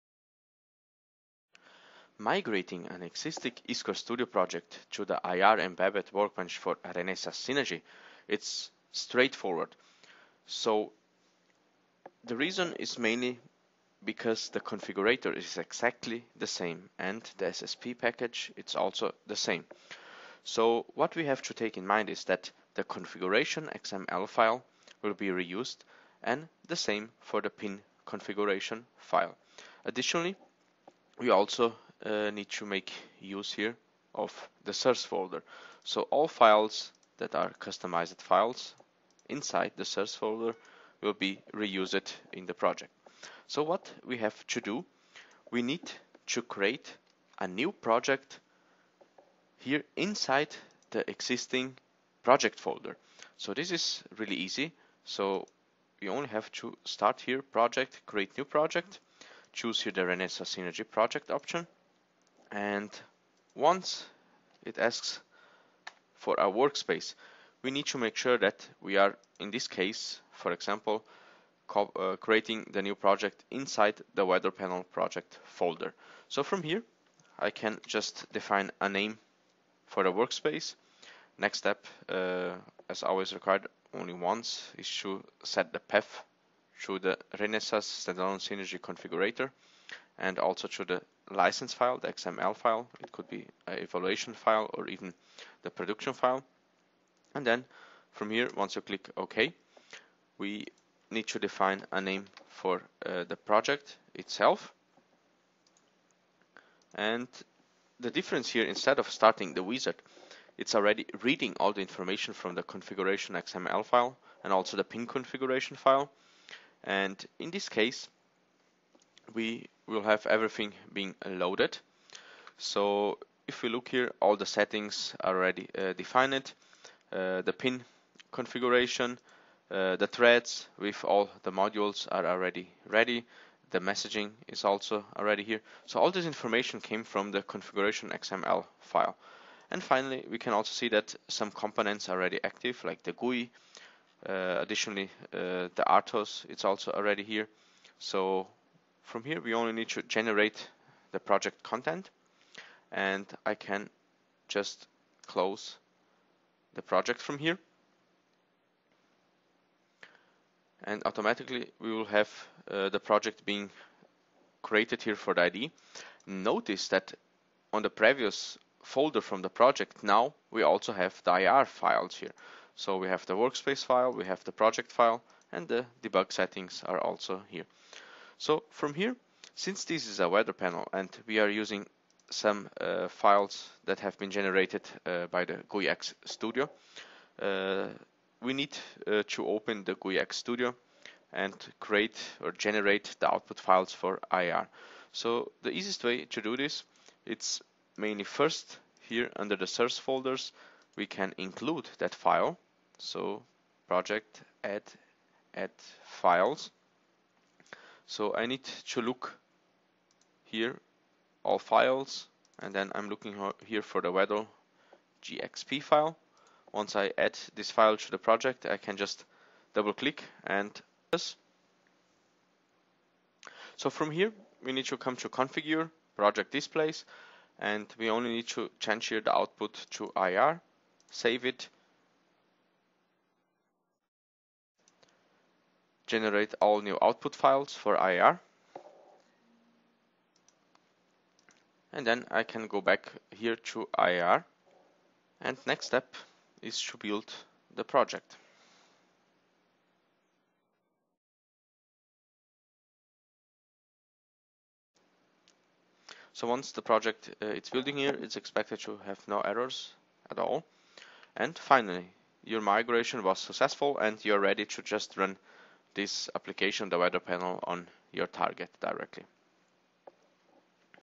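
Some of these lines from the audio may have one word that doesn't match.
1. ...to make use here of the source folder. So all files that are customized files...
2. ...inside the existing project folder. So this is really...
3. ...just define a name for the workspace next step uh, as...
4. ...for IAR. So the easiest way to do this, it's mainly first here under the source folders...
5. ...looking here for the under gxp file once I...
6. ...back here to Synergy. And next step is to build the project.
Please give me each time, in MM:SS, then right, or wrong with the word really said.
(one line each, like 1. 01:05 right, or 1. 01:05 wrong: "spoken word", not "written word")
1. 00:32 right
2. 00:49 right
3. 01:17 right
4. 03:13 right
5. 03:33 wrong: "weather", not "under"
6. 04:02 wrong: "IAR", not "Synergy".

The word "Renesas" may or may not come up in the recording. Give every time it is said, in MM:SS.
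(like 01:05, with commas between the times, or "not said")
00:06, 01:00, 01:27.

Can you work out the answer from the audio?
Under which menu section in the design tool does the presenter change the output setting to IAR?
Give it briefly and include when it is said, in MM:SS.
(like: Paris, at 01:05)
configure project displays, at 03:45.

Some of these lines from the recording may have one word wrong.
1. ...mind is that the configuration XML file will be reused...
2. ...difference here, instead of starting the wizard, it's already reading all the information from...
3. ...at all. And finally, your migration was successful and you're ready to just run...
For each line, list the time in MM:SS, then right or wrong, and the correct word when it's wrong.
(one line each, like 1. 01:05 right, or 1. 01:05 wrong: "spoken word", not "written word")
1. 00:21 right
2. 01:48 right
3. 04:20 right.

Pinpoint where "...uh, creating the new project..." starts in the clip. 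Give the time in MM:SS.
01:11.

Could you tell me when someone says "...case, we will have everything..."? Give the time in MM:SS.
01:57.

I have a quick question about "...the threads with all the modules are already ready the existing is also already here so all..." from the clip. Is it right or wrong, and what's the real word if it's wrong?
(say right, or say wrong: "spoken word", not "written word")
wrong: "messaging", not "existing".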